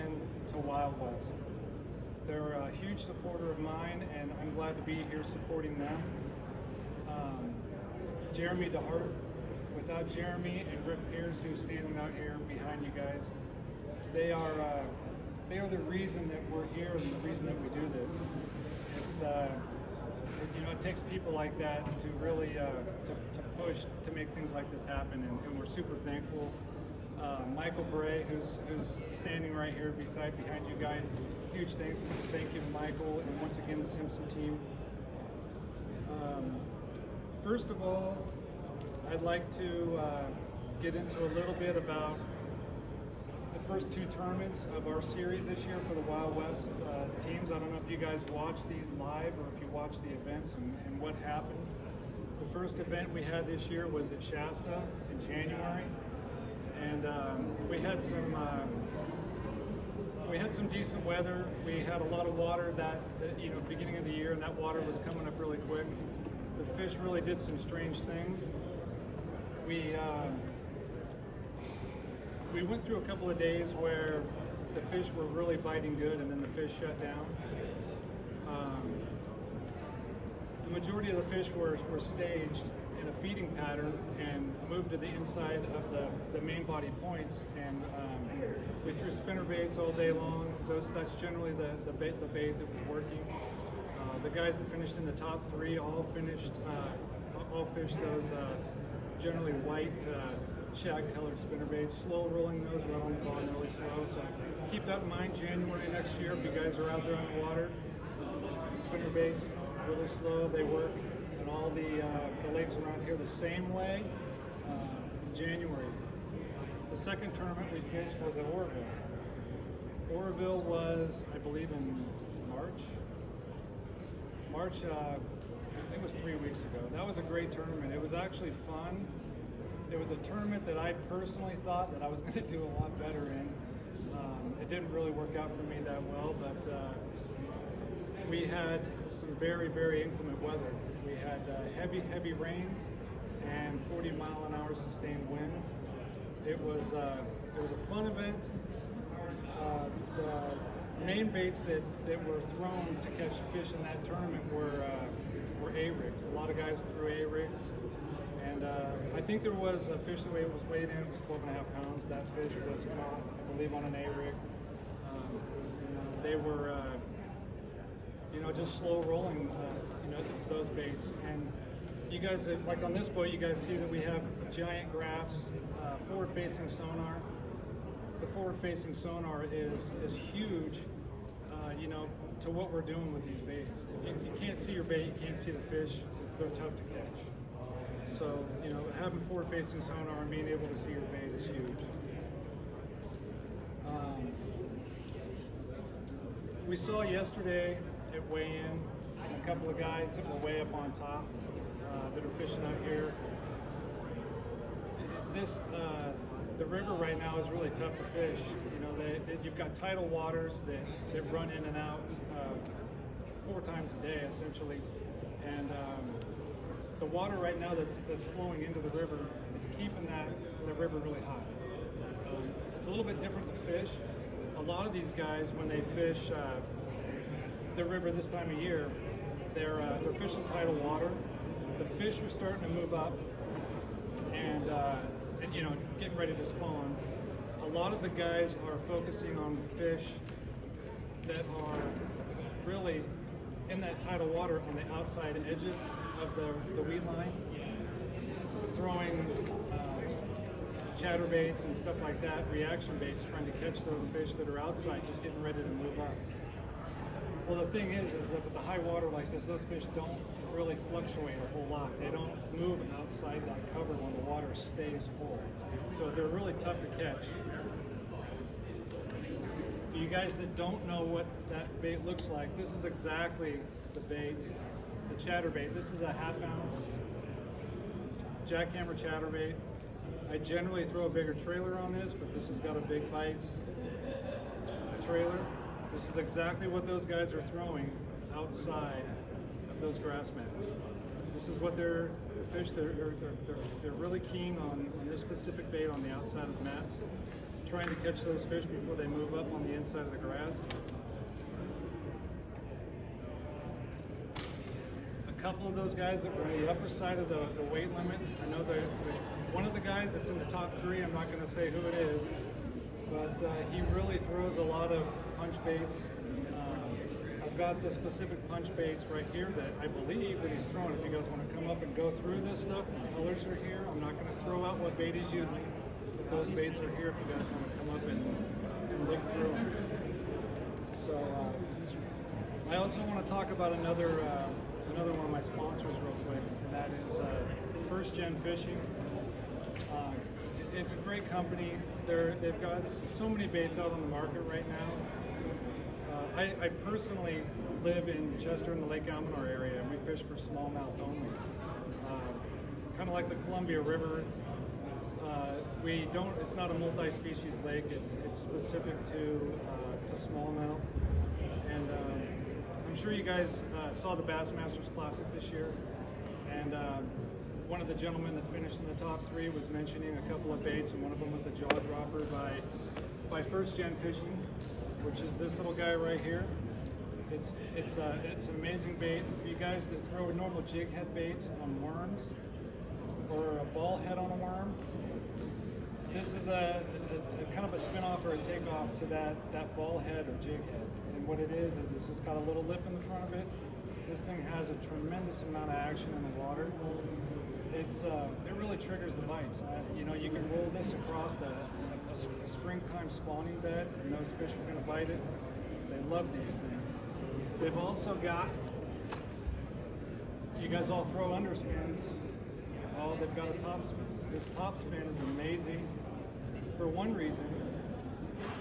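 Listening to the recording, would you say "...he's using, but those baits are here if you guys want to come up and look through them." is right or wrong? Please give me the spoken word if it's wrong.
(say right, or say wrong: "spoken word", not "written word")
right.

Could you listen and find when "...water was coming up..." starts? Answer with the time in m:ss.
1:04.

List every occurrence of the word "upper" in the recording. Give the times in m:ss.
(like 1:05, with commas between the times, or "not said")
5:06.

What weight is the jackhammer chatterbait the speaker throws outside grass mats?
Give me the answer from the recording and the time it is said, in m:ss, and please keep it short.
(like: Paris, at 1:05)
half ounce, at 4:36.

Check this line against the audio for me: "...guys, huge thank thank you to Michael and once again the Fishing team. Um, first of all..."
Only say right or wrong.
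wrong.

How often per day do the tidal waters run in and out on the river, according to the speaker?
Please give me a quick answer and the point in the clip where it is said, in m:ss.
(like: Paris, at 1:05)
4 times, at 3:33.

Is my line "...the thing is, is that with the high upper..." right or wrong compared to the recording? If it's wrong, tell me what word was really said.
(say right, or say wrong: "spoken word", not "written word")
wrong: "water", not "upper".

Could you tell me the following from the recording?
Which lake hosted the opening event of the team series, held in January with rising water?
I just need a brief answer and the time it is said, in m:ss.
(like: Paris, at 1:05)
Shasta, at 0:54.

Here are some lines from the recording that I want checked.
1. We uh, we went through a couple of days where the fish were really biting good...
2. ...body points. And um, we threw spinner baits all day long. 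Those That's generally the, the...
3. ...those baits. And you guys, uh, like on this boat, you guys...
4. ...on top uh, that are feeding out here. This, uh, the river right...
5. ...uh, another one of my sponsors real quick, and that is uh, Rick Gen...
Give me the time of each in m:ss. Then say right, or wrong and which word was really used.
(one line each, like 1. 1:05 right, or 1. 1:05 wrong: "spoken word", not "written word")
1. 1:09 right
2. 1:26 right
3. 2:50 right
4. 3:20 wrong: "fishing", not "feeding"
5. 5:34 wrong: "First", not "Rick".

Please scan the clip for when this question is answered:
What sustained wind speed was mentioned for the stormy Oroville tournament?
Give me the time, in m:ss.
2:23.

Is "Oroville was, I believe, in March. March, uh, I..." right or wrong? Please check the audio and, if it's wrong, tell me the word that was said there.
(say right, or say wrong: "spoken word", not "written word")
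right.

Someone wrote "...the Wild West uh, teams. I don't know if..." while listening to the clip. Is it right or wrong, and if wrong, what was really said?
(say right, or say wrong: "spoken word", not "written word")
right.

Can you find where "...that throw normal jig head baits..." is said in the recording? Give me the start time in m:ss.
6:19.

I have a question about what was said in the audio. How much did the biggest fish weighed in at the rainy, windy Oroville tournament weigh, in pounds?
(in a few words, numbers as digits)
12.5.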